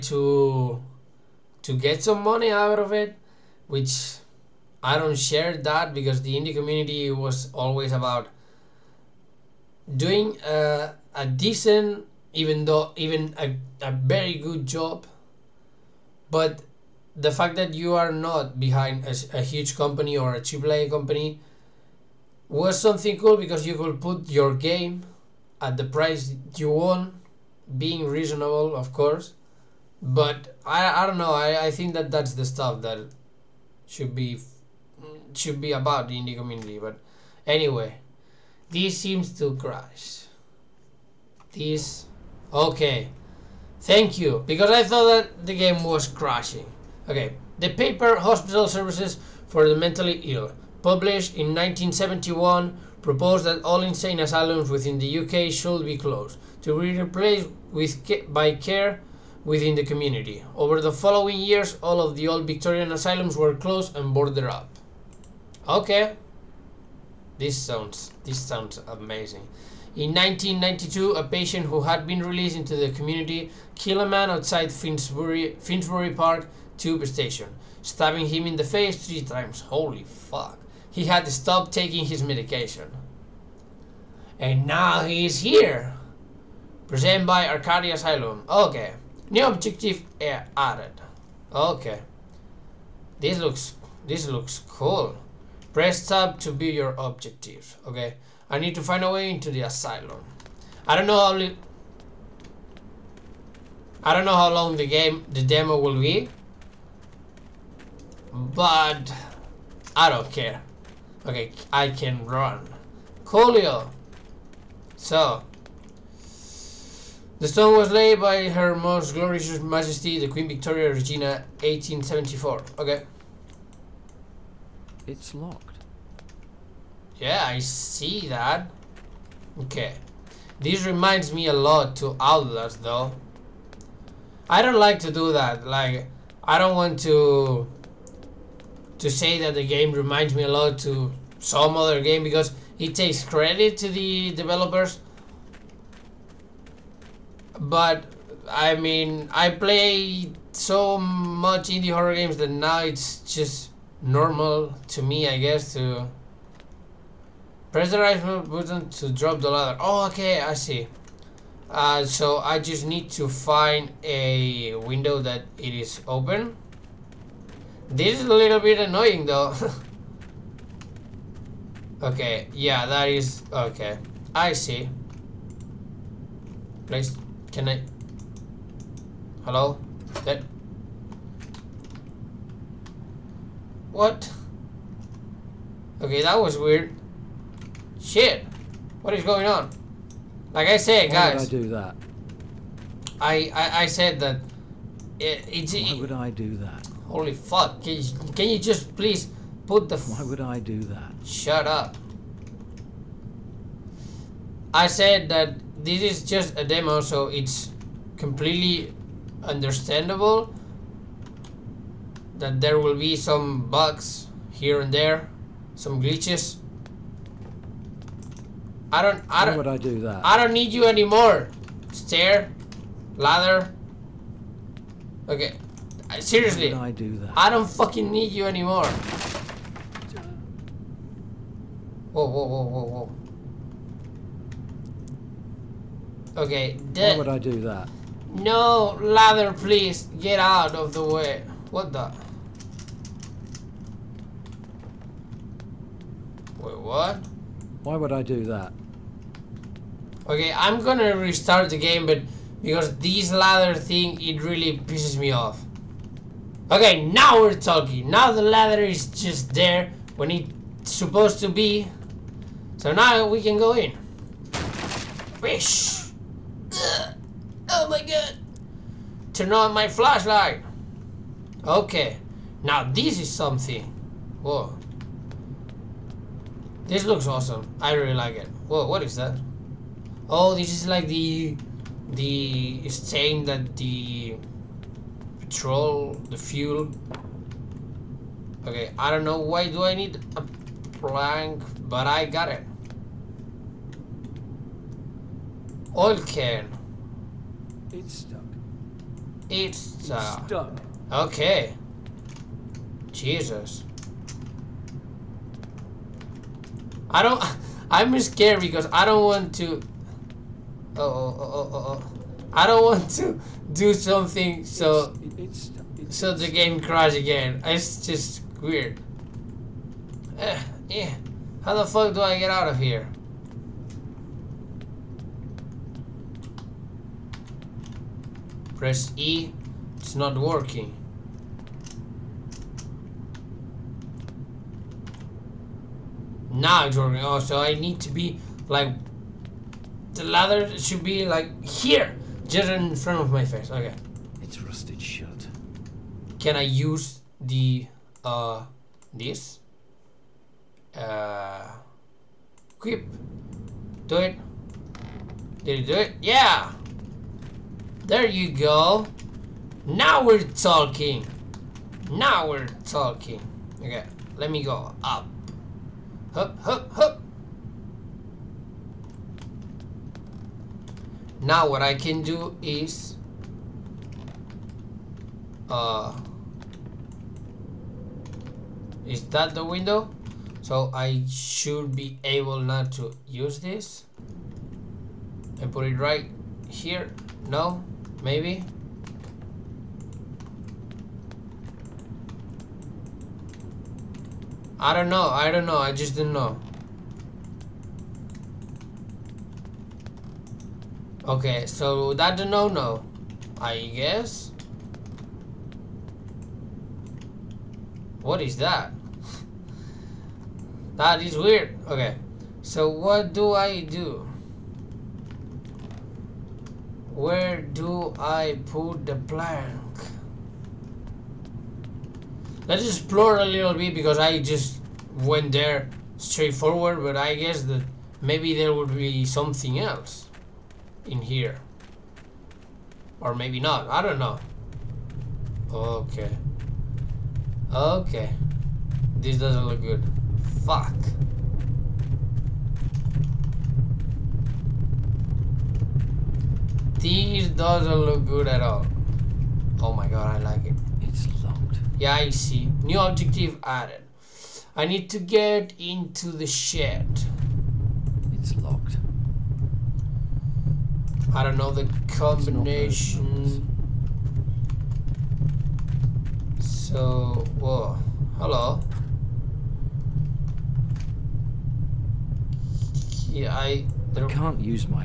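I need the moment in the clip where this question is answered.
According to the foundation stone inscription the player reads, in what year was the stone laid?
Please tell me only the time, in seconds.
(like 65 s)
121 s.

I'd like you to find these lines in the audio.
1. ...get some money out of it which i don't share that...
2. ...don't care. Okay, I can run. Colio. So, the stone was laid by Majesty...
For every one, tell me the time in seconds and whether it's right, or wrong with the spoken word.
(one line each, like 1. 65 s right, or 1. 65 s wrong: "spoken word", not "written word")
1. 1 s right
2. 110 s wrong: "Her", not "Majesty".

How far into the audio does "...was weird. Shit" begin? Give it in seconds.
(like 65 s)
186 s.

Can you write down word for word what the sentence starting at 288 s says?
Okay, I don't know why do I need a plank, but I got it.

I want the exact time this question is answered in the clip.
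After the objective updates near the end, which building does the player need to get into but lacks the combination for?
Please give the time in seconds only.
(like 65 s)
456 s.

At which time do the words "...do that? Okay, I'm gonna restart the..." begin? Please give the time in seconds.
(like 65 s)
248 s.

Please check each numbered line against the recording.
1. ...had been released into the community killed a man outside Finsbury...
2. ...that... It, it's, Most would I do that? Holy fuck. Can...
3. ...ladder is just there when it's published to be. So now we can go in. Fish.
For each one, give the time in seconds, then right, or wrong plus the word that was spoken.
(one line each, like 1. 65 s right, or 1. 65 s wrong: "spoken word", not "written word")
1. 71 s right
2. 194 s wrong: "Why", not "Most"
3. 258 s wrong: "supposed", not "published".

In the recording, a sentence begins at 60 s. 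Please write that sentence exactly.
Over the following years, all of the old Victorian asylums were closed and boarded up.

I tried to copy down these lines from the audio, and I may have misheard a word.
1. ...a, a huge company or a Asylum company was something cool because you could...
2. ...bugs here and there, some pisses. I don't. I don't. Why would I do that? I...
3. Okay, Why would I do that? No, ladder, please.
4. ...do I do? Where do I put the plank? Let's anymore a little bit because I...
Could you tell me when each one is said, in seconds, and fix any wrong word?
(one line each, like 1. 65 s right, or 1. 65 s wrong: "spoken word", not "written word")
1. 19 s wrong: "AAA", not "Asylum"
2. 213 s wrong: "glitches", not "pisses"
3. 236 s right
4. 413 s wrong: "explore", not "anymore".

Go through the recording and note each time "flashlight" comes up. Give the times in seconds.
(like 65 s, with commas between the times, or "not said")
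269 s.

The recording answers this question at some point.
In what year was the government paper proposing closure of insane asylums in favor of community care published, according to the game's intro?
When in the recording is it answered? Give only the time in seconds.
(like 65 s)
51 s.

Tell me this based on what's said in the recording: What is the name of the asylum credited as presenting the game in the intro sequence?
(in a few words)
Arcadia Asylum.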